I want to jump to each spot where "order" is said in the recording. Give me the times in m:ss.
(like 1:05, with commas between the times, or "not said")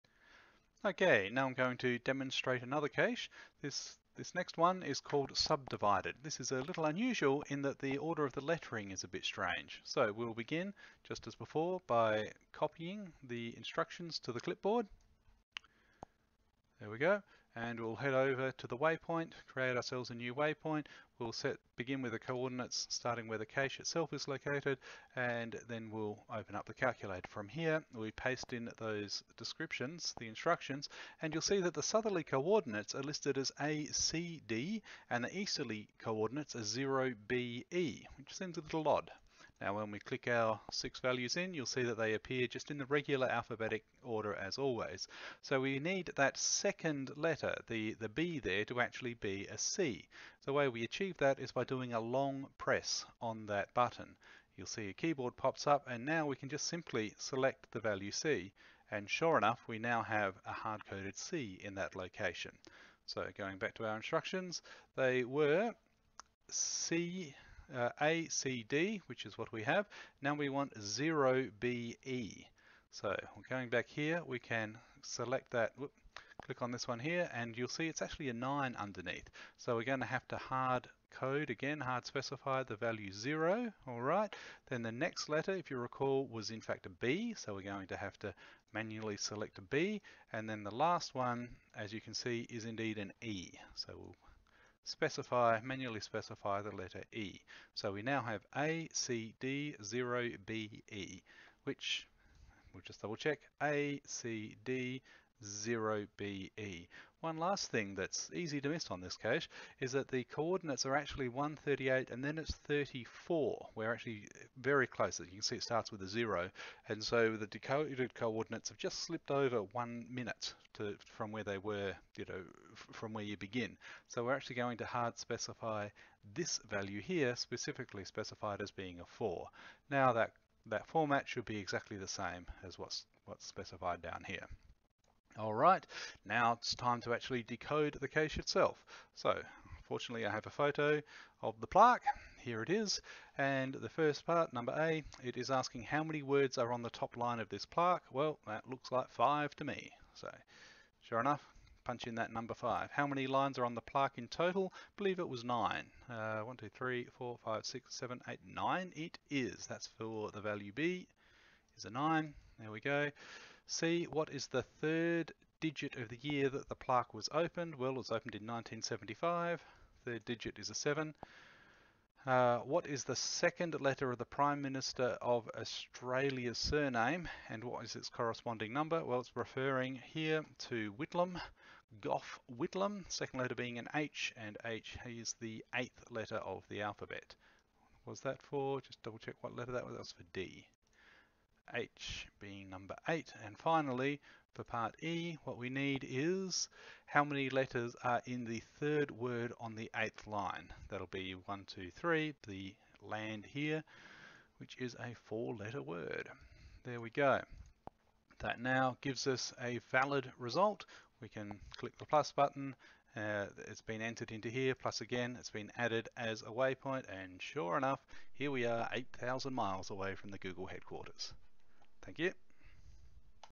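0:07, 0:44.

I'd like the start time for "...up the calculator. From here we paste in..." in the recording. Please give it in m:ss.
0:26.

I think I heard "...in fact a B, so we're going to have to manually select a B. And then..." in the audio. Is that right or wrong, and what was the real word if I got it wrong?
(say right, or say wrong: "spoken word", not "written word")
right.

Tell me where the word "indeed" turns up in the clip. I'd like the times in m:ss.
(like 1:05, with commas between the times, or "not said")
1:32.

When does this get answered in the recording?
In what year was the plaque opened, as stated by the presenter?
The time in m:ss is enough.
2:48.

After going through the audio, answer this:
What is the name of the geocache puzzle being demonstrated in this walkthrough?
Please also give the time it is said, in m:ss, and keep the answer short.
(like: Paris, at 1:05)
subdivided, at 0:05.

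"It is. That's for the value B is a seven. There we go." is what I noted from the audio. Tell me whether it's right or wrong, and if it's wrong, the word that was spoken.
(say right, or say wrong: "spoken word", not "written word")
wrong: "nine", not "seven".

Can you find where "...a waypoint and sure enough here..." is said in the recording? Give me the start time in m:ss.
3:36.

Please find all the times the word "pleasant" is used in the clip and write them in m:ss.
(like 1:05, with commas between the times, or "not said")
not said.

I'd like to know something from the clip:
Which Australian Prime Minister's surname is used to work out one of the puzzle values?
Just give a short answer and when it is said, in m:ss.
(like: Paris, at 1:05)
Gough Whitlam, at 3:00.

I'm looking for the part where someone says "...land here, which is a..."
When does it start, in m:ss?
3:23.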